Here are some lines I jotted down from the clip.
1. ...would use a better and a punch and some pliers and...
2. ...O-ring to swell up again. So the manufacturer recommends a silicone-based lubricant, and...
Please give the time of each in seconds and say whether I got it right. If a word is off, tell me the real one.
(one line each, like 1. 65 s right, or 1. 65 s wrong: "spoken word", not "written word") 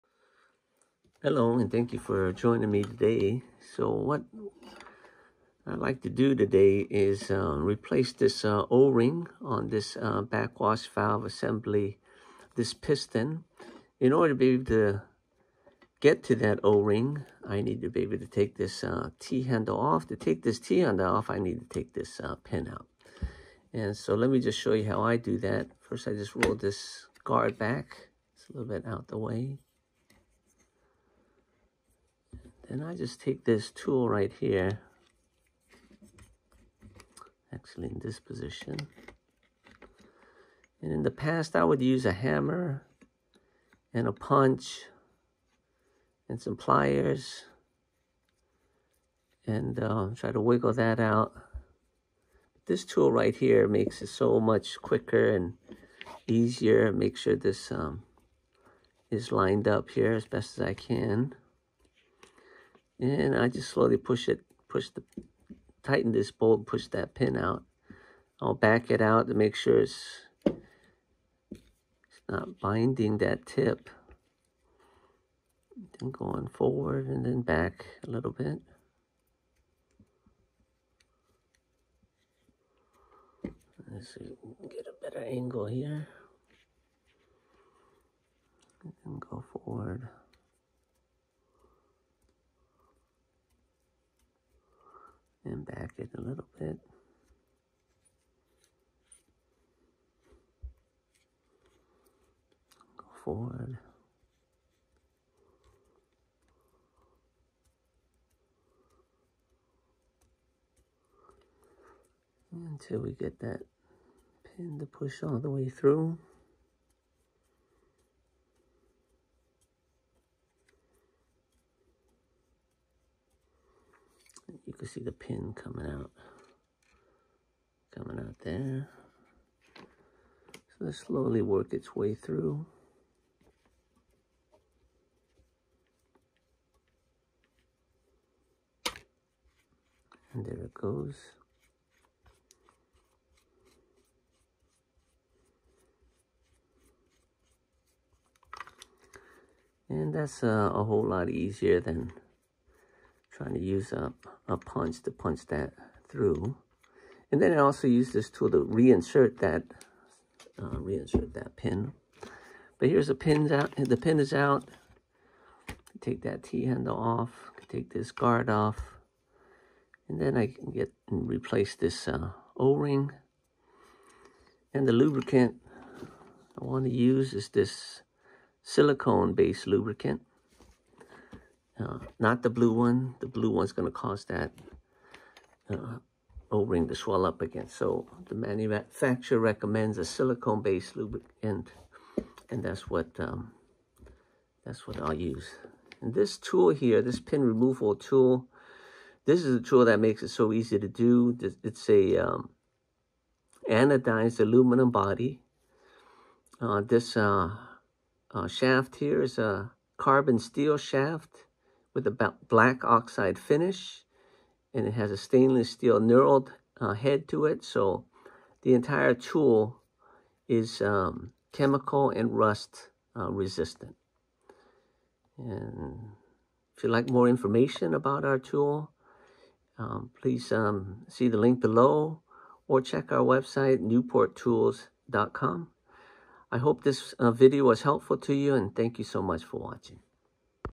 1. 41 s wrong: "hammer", not "better"
2. 186 s right.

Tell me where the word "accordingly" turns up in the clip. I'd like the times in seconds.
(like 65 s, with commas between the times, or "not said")
not said.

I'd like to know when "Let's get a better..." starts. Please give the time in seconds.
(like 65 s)
83 s.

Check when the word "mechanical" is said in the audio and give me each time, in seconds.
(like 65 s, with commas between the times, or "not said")
not said.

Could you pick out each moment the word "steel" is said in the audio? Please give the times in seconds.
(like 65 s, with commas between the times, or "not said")
210 s, 215 s.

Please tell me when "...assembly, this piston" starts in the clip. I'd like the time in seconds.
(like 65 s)
11 s.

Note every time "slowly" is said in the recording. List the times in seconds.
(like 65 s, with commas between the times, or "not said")
63 s, 130 s.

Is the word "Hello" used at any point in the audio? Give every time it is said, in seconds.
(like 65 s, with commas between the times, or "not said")
1 s.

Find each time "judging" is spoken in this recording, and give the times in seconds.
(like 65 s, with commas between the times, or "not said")
not said.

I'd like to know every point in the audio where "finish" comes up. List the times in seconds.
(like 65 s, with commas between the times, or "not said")
213 s.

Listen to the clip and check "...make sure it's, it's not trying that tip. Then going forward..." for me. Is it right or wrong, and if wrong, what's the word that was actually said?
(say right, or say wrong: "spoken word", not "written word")
wrong: "binding", not "trying".